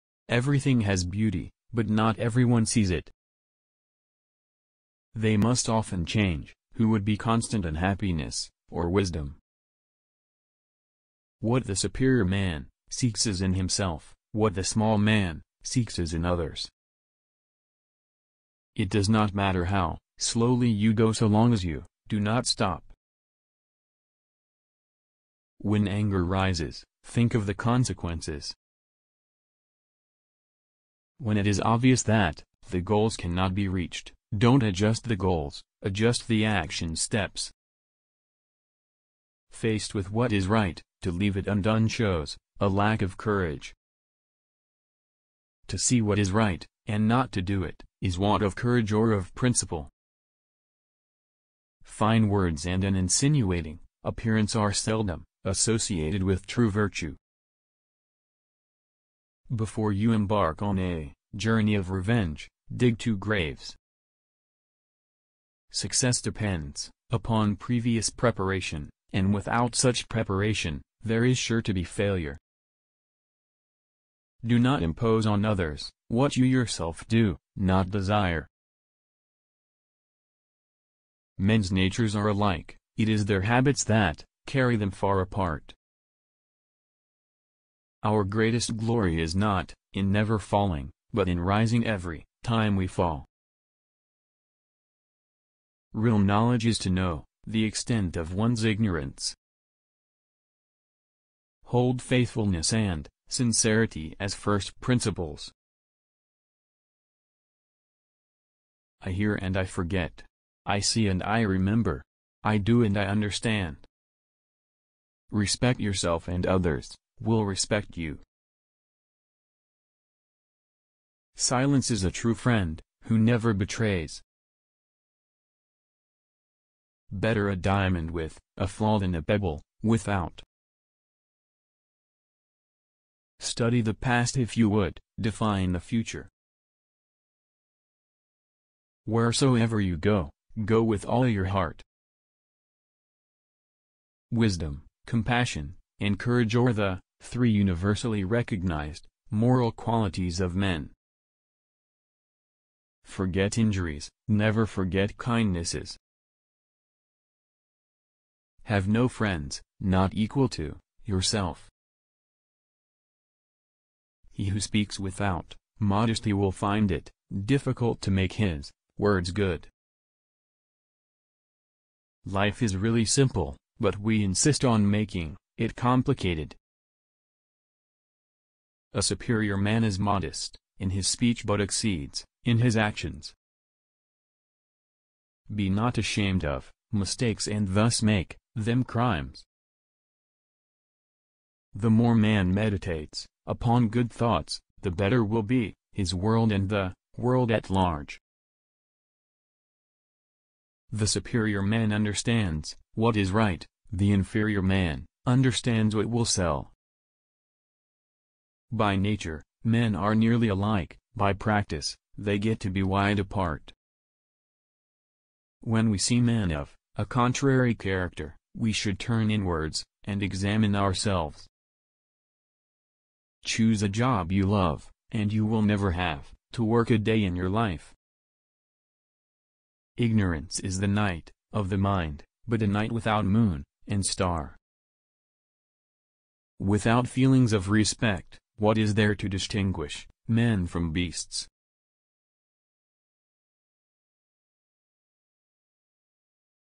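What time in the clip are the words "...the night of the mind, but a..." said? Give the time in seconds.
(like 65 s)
230 s.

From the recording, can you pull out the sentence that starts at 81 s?
Men's natures are alike, it is their habits that carry them far apart.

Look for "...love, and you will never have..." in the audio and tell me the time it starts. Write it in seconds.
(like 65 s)
224 s.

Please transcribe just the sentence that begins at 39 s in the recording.
Faced with what is right, to leave it undone shows a lack of courage.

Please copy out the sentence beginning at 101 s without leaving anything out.
Hold faithfulness and sincerity as first principles.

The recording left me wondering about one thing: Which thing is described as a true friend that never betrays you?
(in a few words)
Silence.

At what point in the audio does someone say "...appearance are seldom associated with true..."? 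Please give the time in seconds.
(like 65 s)
54 s.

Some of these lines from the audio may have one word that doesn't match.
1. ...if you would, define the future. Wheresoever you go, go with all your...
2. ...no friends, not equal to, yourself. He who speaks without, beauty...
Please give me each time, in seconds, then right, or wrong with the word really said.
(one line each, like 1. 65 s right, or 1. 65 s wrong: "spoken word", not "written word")
1. 134 s right
2. 158 s wrong: "modesty", not "beauty".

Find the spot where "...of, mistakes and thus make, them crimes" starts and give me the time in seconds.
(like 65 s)
186 s.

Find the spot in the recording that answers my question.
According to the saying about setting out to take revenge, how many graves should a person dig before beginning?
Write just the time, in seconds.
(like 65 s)
62 s.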